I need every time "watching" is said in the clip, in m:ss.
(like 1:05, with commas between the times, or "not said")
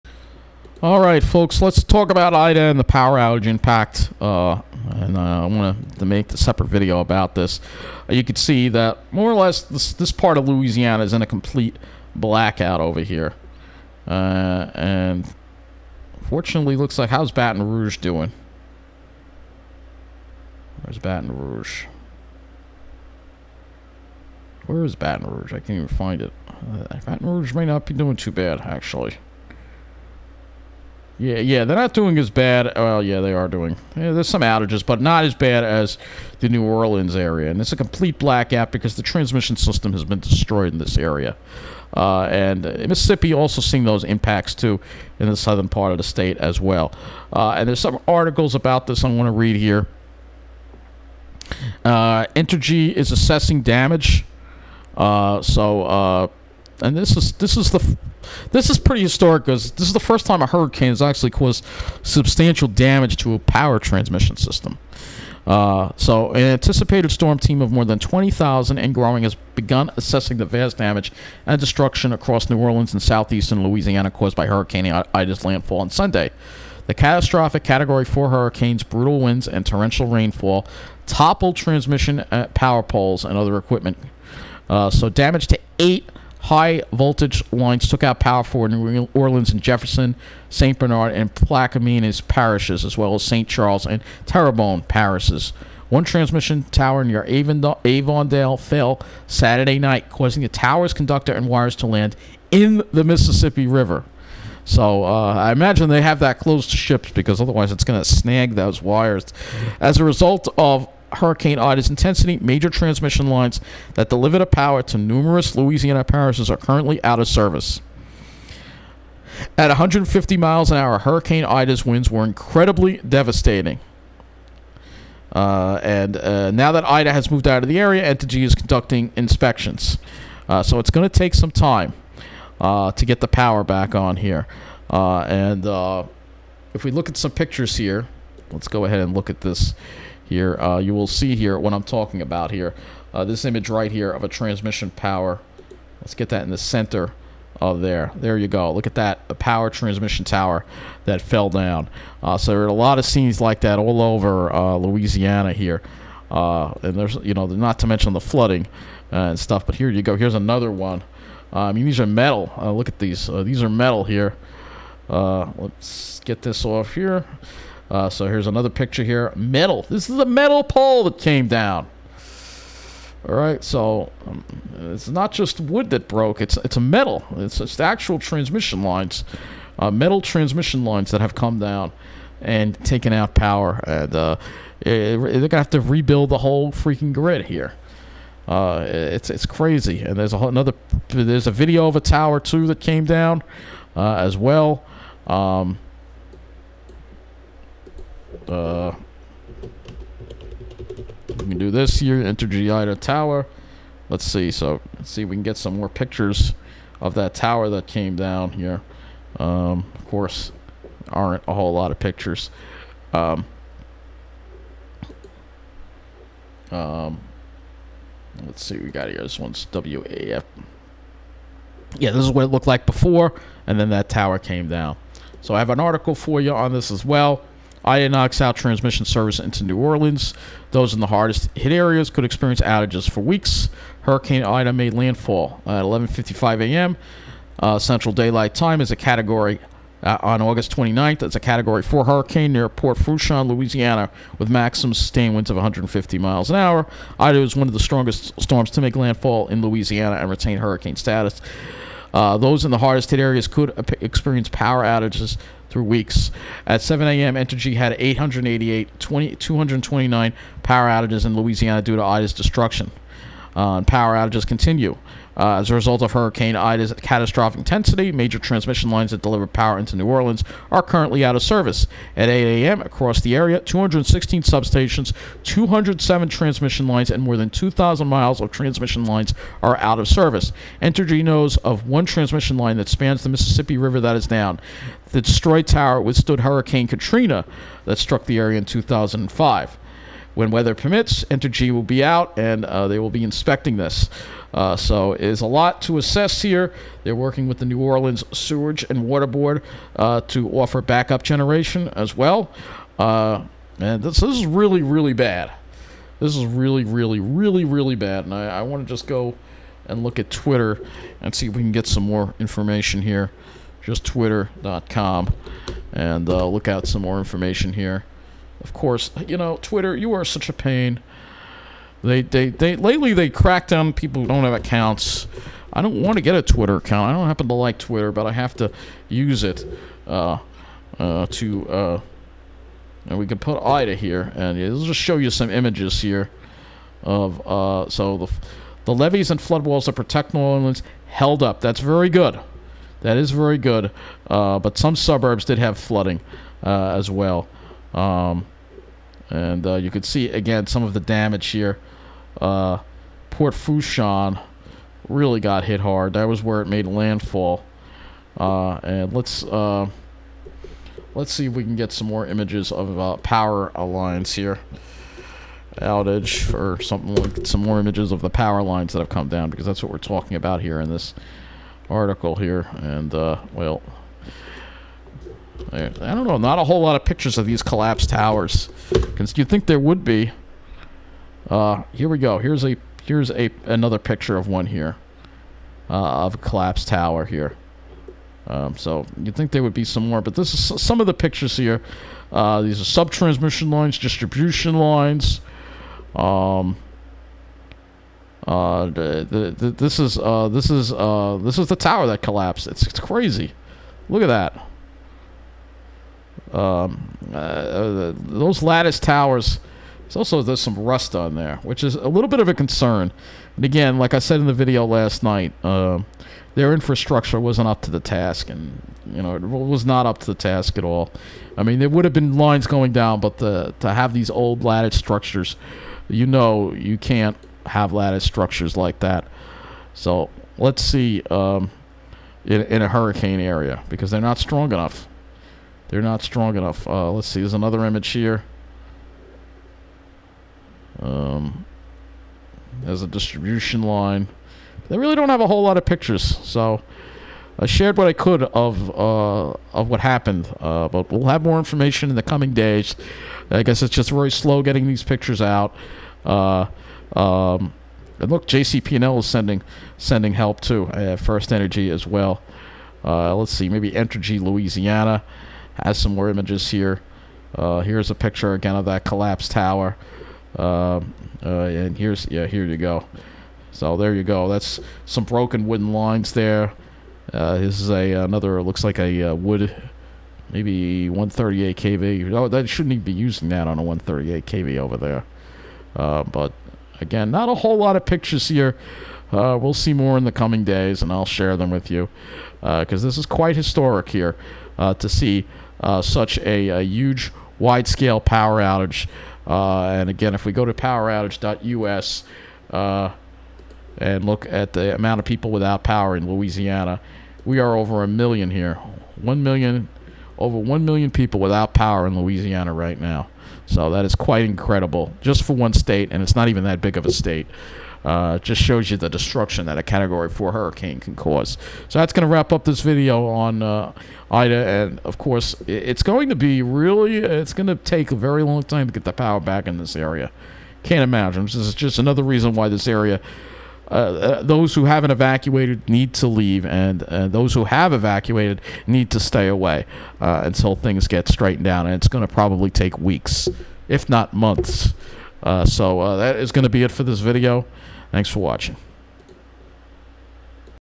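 9:08.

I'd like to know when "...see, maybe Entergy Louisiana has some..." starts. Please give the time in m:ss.
7:43.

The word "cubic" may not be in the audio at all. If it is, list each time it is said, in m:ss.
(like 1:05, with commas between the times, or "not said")
not said.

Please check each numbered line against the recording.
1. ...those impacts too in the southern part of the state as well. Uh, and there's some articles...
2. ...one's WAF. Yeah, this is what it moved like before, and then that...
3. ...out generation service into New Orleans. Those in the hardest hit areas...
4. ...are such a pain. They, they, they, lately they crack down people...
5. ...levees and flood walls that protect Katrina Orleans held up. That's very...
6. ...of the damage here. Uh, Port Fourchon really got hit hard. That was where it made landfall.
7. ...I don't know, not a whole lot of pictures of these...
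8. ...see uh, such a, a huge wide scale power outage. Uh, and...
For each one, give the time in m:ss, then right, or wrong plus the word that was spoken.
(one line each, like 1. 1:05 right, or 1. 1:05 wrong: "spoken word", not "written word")
1. 0:43 right
2. 3:39 wrong: "looked", not "moved"
3. 3:48 wrong: "transmission", not "generation"
4. 5:20 right
5. 5:38 wrong: "New", not "Katrina"
6. 5:50 right
7. 6:15 right
8. 8:15 right.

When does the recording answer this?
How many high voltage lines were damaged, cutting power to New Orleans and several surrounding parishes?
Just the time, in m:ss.
1:25.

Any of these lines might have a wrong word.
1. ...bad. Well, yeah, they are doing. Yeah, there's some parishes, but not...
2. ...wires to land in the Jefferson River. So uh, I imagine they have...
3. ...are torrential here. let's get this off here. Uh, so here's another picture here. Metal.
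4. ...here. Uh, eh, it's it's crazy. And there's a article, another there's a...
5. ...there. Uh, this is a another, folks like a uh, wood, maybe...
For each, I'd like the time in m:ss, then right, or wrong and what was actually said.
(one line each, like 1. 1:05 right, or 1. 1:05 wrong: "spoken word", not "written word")
1. 0:32 wrong: "outages", not "parishes"
2. 1:41 wrong: "Mississippi", not "Jefferson"
3. 2:43 wrong: "metal", not "torrential"
4. 3:07 wrong: "whole", not "article"
5. 7:56 wrong: "looks", not "folks".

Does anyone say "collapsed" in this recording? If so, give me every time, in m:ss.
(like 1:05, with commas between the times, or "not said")
6:17, 6:26, 6:42, 7:49.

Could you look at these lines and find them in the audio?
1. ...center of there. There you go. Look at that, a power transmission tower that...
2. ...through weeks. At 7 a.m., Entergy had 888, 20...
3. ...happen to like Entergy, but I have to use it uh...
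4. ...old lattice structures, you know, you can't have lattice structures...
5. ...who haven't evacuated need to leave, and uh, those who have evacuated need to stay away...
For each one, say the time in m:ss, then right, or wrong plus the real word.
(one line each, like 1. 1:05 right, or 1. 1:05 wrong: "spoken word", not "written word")
1. 2:26 right
2. 4:15 right
3. 5:27 wrong: "Twitter", not "Entergy"
4. 7:04 right
5. 8:54 right.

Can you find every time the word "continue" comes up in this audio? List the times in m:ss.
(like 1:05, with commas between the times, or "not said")
4:24.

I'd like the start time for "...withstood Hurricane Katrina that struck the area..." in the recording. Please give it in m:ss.
4:46.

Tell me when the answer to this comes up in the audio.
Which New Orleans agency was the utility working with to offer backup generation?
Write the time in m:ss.
4:58.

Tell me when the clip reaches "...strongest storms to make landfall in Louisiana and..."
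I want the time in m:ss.
4:07.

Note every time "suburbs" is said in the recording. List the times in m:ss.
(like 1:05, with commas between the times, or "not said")
5:44.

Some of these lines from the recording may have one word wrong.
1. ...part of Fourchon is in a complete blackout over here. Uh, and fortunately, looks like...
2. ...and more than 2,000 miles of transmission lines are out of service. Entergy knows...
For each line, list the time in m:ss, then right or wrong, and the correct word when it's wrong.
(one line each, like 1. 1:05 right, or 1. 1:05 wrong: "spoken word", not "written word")
1. 0:10 wrong: "Louisiana", not "Fourchon"
2. 4:37 right.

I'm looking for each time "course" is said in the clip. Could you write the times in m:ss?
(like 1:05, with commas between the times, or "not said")
3:30, 5:18, 8:45.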